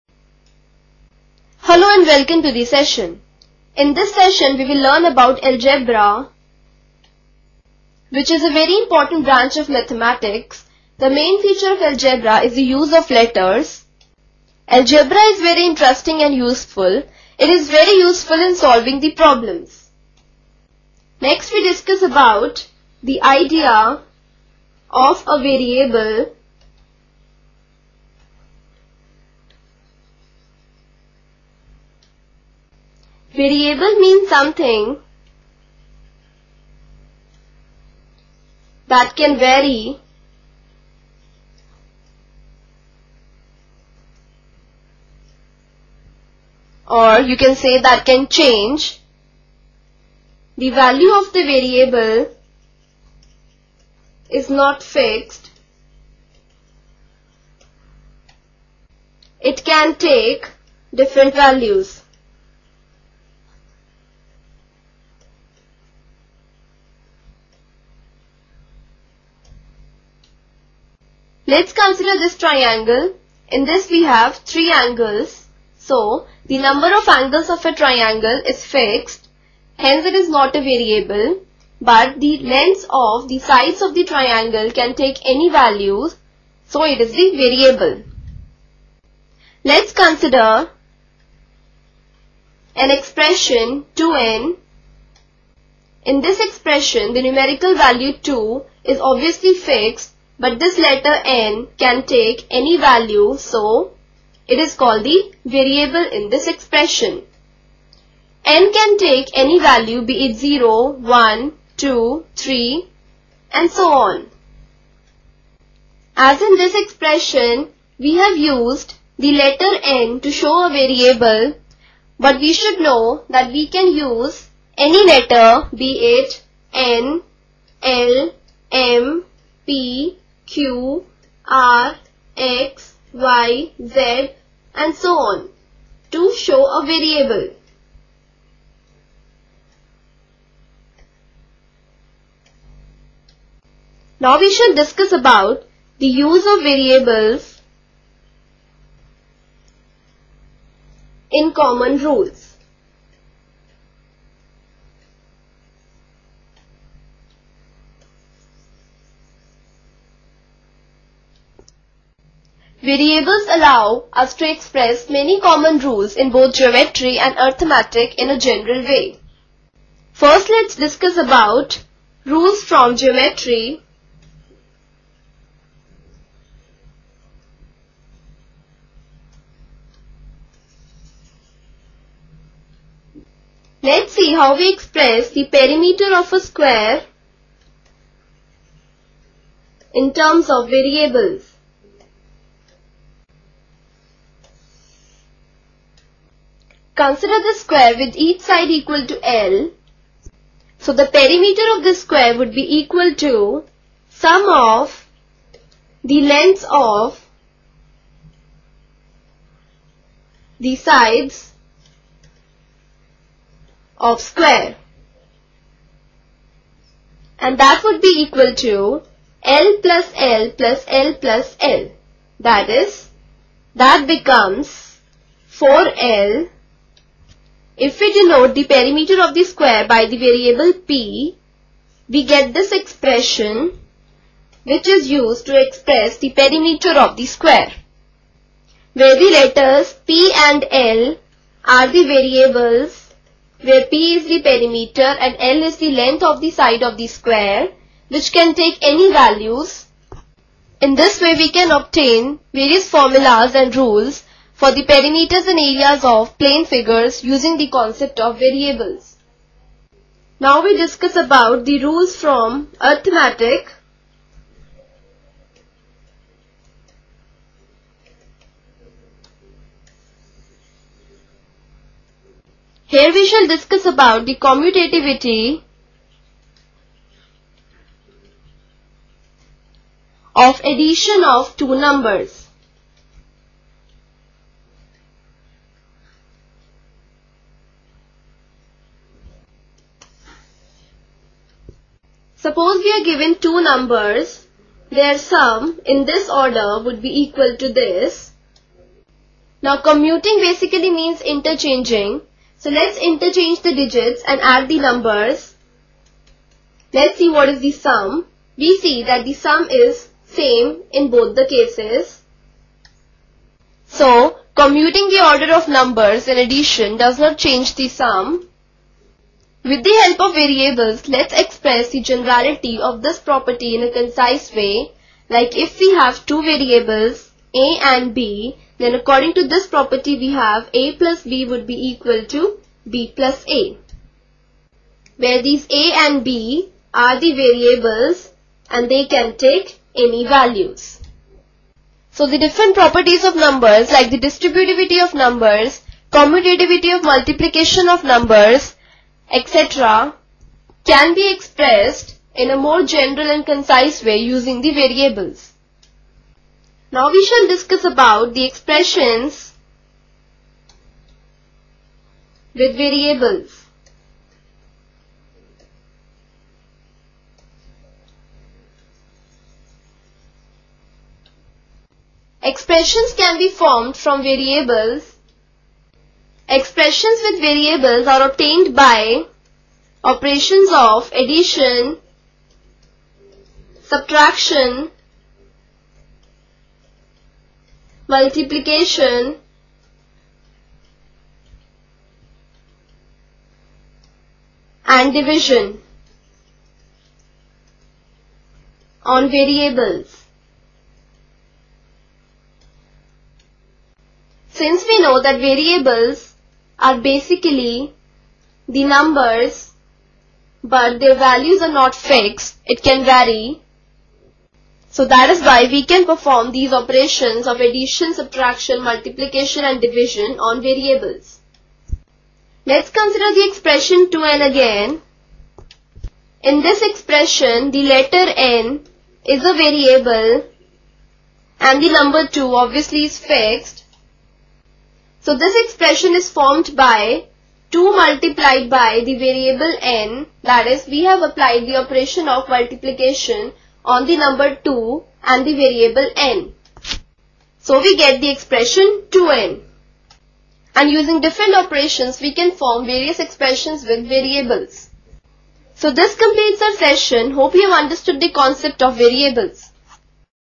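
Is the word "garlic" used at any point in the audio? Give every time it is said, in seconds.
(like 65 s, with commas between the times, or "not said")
not said.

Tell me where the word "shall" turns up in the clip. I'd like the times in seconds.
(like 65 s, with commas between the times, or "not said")
144 s, 273 s, 357 s.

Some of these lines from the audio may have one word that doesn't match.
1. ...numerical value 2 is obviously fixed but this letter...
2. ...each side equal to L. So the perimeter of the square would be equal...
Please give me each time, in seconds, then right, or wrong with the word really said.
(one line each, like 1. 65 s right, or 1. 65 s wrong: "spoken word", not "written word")
1. 97 s right
2. 198 s right.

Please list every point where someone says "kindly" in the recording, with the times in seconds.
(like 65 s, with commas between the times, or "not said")
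not said.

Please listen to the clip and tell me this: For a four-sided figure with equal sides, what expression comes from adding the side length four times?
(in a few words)
4L.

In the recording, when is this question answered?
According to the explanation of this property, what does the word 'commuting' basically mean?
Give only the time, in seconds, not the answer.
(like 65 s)
301 s.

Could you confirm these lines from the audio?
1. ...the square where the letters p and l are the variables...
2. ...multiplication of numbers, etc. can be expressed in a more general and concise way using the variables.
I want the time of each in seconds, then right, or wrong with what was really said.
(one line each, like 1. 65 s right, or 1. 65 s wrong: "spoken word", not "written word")
1. 237 s right
2. 347 s right.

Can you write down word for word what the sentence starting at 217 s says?
And that would be equal to L plus L plus L plus L.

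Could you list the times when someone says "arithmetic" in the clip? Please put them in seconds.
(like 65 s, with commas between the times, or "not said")
167 s, 262 s.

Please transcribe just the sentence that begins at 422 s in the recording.
Let's consider the expression 2n again.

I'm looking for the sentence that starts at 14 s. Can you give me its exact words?
Algebra is very interesting and useful.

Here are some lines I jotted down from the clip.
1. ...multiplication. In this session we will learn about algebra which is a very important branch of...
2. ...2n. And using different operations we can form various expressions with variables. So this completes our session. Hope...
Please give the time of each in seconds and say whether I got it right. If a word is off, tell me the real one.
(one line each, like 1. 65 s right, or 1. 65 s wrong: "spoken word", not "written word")
1. 2 s wrong: "session", not "multiplication"
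2. 449 s right.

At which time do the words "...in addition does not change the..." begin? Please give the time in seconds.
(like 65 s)
316 s.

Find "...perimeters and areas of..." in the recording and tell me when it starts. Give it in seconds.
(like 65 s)
254 s.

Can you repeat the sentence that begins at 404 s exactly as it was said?
Since we know that variables are basically the numbers but their values are not fixed.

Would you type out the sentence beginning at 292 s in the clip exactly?
Suppose we are given two numbers, their sum in this order would be equal to this.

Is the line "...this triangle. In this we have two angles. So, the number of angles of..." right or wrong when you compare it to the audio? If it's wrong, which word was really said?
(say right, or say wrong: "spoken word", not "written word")
wrong: "three", not "two".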